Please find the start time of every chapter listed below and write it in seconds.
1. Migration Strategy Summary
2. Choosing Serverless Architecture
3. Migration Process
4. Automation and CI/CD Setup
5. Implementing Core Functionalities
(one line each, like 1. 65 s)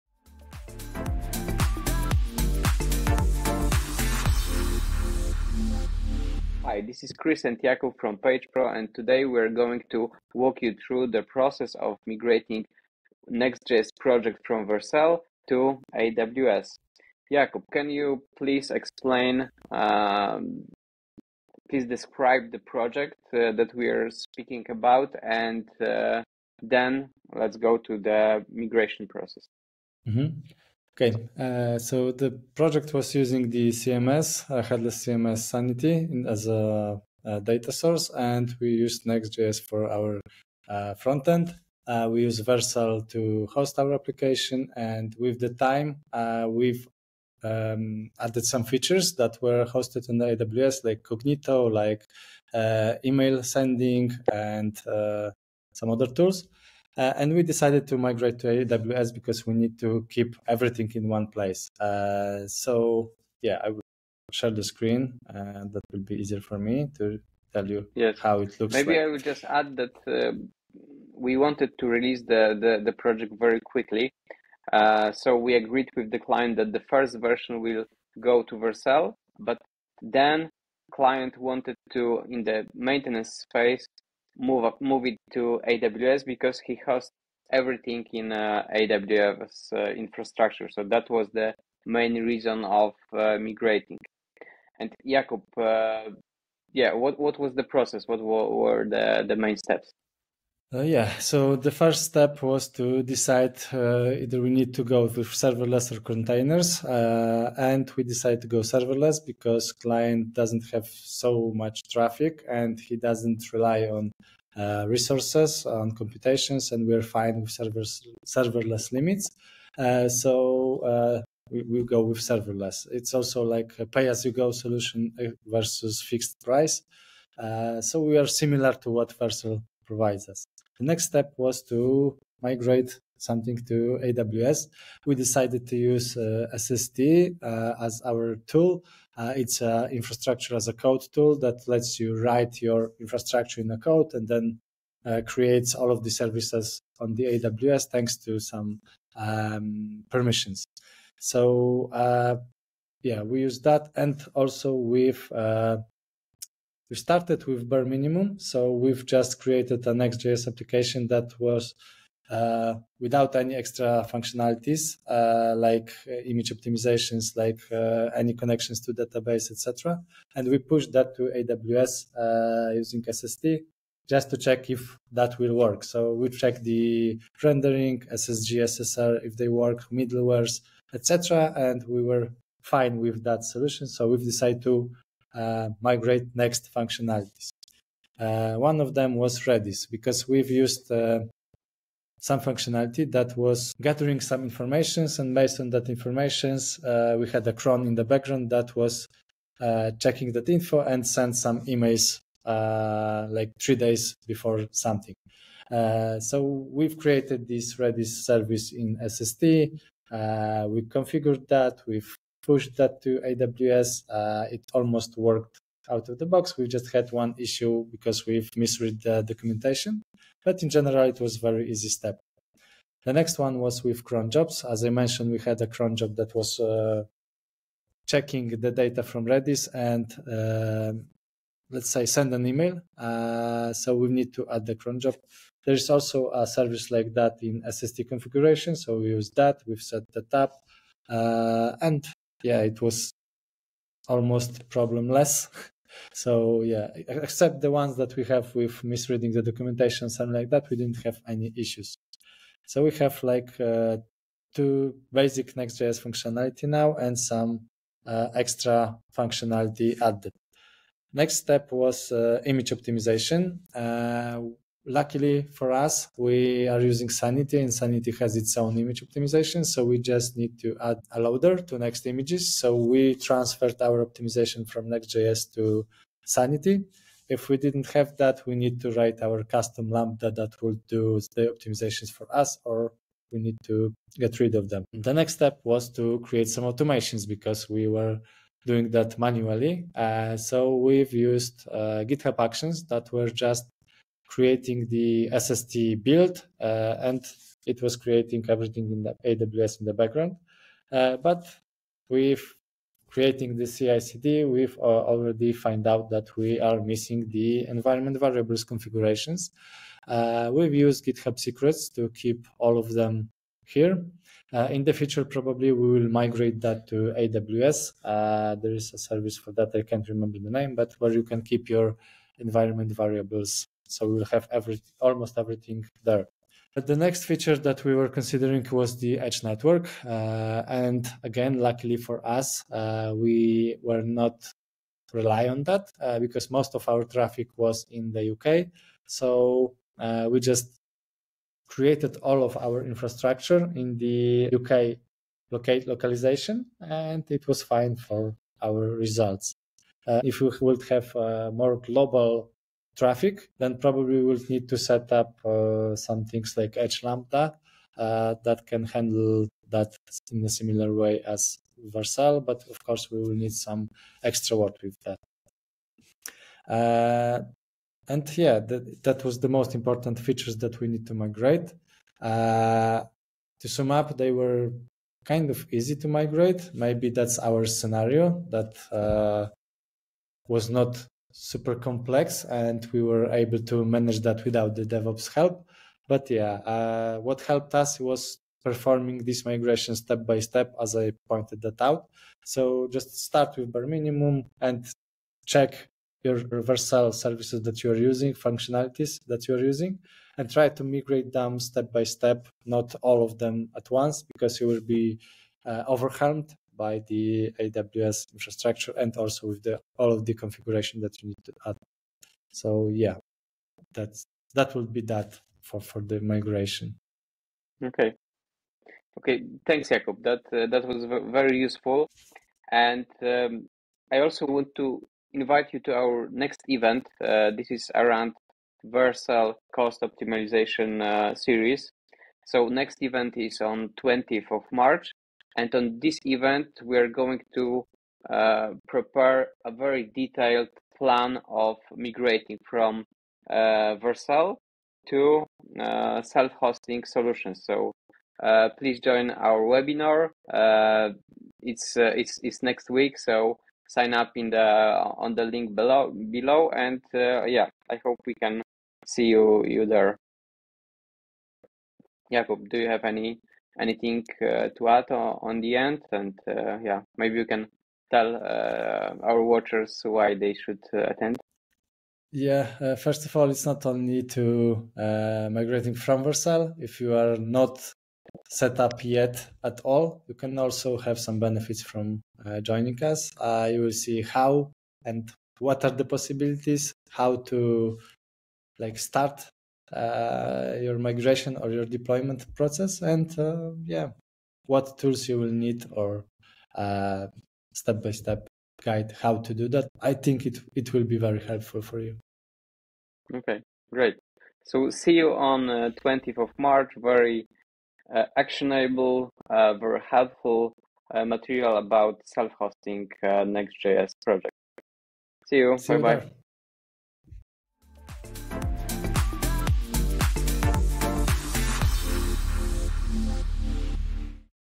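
1. 368 s
2. 94 s
3. 24 s
4. 291 s
5. 179 s.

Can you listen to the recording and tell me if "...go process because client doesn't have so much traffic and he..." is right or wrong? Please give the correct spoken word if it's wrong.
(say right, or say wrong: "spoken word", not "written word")
wrong: "serverless", not "process".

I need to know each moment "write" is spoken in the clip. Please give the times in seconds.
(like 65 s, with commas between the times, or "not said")
142 s, 278 s.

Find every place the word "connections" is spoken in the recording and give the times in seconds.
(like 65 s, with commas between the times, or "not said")
168 s.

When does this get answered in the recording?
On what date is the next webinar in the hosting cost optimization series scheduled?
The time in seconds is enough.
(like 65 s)
434 s.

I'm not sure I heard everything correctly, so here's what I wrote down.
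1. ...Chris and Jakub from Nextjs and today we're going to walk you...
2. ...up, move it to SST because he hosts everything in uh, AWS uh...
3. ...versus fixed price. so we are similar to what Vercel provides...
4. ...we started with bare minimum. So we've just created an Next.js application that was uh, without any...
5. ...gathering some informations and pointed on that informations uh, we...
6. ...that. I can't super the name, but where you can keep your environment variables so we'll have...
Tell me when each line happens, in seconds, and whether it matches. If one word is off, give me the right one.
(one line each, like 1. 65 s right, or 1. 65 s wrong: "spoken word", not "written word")
1. 7 s wrong: "PagePro", not "Nextjs"
2. 84 s wrong: "AWS", not "SST"
3. 125 s right
4. 156 s right
5. 193 s wrong: "based", not "pointed"
6. 319 s wrong: "remember", not "super".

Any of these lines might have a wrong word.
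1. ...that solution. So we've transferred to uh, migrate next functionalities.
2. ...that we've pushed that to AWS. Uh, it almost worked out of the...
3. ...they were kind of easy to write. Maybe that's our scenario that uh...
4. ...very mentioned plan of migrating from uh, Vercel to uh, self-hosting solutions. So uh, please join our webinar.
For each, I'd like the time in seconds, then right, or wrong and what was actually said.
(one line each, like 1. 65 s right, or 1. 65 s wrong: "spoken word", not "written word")
1. 183 s wrong: "decided", not "transferred"
2. 211 s right
3. 374 s wrong: "migrate", not "write"
4. 439 s wrong: "detailed", not "mentioned".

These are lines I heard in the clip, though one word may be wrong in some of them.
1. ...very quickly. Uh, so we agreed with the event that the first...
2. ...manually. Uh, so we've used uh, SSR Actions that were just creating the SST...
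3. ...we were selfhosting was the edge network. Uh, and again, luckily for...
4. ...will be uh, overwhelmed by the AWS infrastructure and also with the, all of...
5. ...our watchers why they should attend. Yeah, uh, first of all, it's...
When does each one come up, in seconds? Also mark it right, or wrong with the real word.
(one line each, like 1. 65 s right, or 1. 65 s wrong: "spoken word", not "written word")
1. 73 s wrong: "client", not "event"
2. 289 s wrong: "GitHub", not "SSR"
3. 327 s wrong: "considering", not "selfhosting"
4. 404 s right
5. 469 s right.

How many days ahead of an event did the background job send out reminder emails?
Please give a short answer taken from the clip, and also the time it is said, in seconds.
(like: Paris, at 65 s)
3, at 203 s.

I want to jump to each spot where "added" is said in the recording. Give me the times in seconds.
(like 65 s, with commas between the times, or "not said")
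48 s, 260 s.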